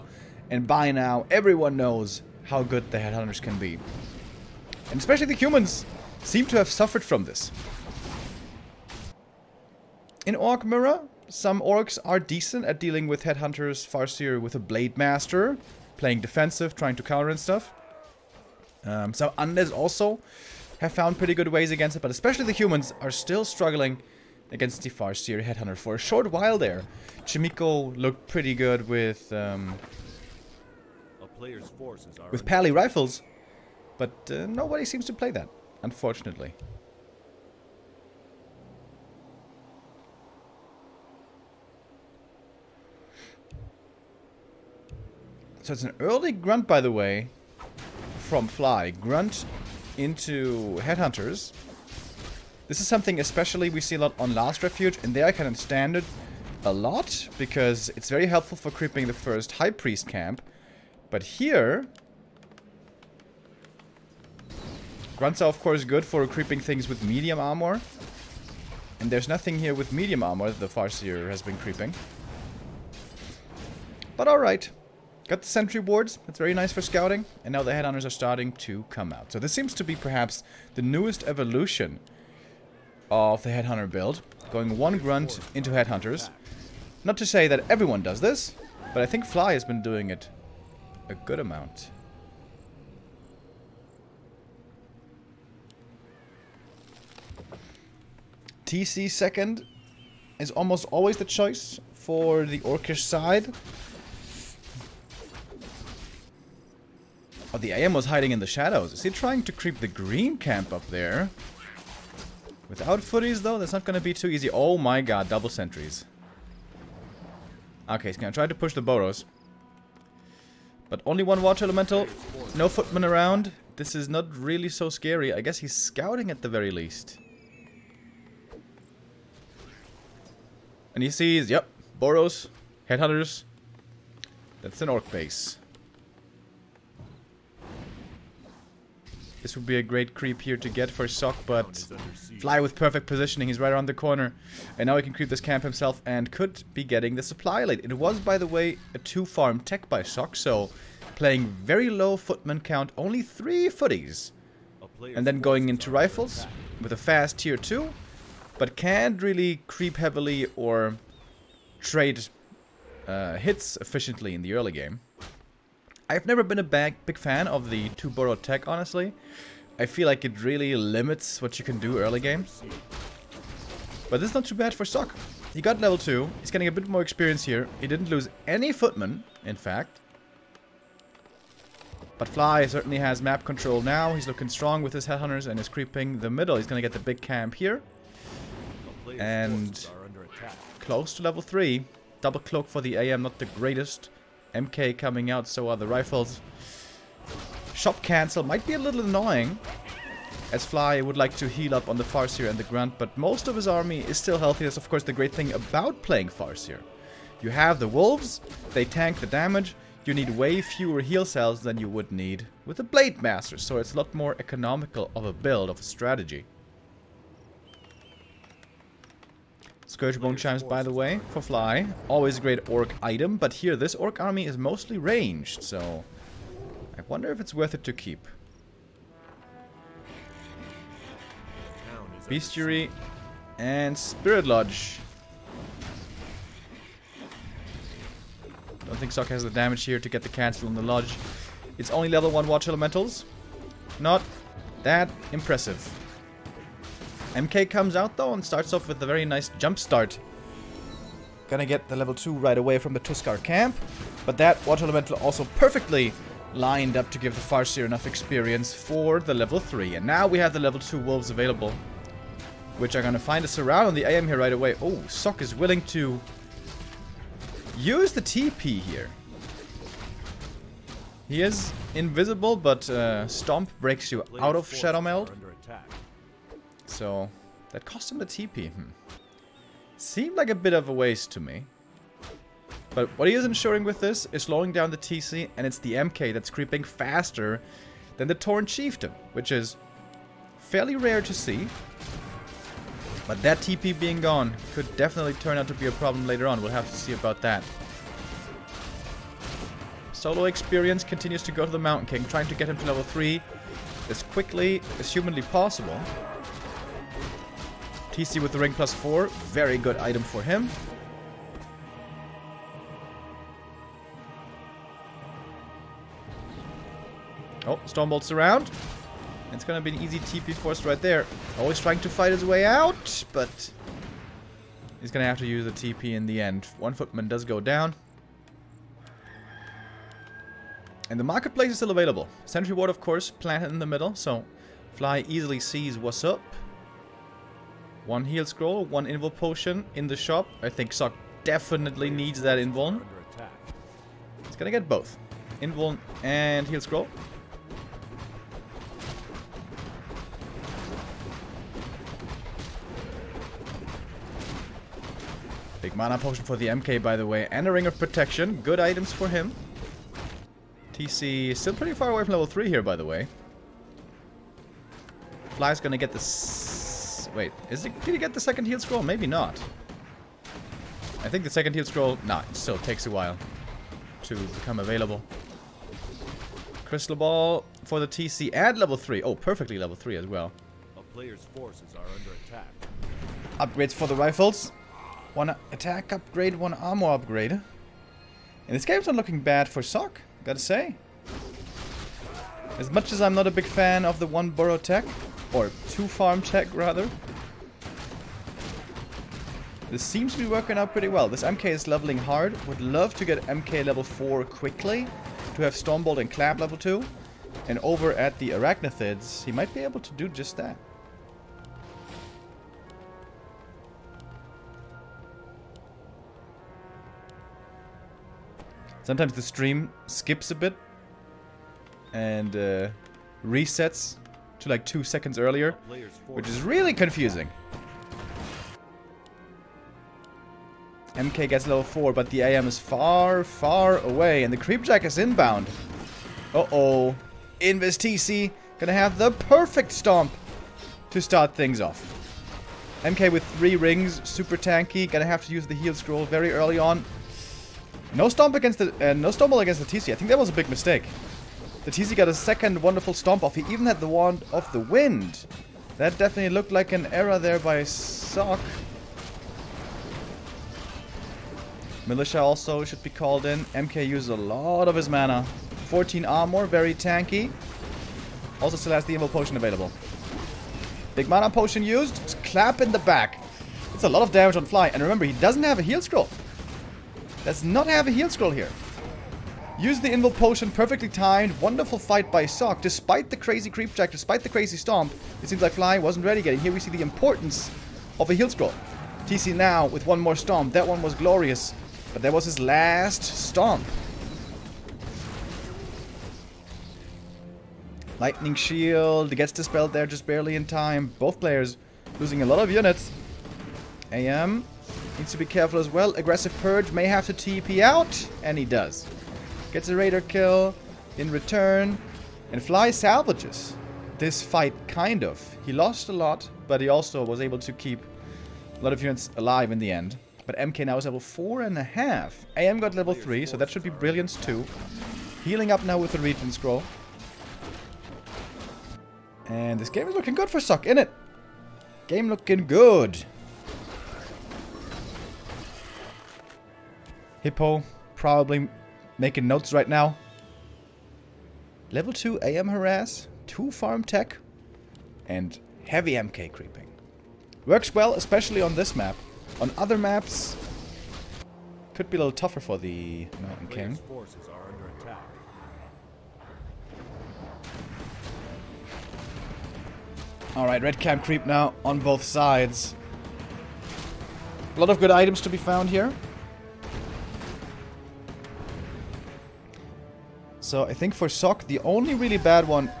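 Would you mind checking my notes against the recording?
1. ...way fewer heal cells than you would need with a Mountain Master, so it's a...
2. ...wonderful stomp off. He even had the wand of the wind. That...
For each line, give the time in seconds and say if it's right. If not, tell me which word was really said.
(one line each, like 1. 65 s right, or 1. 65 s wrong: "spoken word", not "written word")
1. 210 s wrong: "Blade", not "Mountain"
2. 452 s right.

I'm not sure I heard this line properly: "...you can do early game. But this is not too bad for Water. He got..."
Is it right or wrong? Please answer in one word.
wrong.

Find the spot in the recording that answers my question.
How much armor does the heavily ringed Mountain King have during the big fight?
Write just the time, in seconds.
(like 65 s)
465 s.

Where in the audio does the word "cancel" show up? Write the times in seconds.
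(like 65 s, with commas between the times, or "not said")
198 s, 240 s.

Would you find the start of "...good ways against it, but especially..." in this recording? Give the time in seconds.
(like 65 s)
21 s.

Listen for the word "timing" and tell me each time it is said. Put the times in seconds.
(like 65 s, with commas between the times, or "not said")
not said.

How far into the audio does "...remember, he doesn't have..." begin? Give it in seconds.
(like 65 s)
475 s.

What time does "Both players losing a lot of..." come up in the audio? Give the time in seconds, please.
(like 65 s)
501 s.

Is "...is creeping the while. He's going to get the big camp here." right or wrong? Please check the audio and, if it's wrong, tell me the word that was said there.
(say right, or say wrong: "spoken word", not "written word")
wrong: "middle", not "while".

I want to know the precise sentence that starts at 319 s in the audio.
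It's gonna be an easy TP force right there.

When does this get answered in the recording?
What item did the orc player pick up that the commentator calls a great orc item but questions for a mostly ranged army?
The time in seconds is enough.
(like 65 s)
220 s.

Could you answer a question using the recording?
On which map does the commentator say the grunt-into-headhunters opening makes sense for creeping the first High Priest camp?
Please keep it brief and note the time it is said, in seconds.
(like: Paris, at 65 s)
Last Refuge, at 54 s.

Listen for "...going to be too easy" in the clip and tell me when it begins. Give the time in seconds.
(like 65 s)
113 s.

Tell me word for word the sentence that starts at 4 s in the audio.
And especially the humans seem to have suffered from this.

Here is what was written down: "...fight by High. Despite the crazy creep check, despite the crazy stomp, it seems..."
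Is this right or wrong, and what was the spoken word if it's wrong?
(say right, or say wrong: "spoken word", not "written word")
wrong: "Sok", not "High".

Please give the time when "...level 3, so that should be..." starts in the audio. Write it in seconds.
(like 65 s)
522 s.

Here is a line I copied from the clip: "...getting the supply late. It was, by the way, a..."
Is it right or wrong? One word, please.
right.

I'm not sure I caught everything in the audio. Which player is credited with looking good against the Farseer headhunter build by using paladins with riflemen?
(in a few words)
Chaemiko.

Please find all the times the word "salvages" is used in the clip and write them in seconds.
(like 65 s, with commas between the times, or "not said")
512 s.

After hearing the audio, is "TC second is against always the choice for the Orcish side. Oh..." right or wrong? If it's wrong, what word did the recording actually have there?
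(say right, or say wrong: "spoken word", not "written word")
wrong: "almost", not "against".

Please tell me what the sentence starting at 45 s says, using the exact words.
So it's an early grunt, by the way, from Fly.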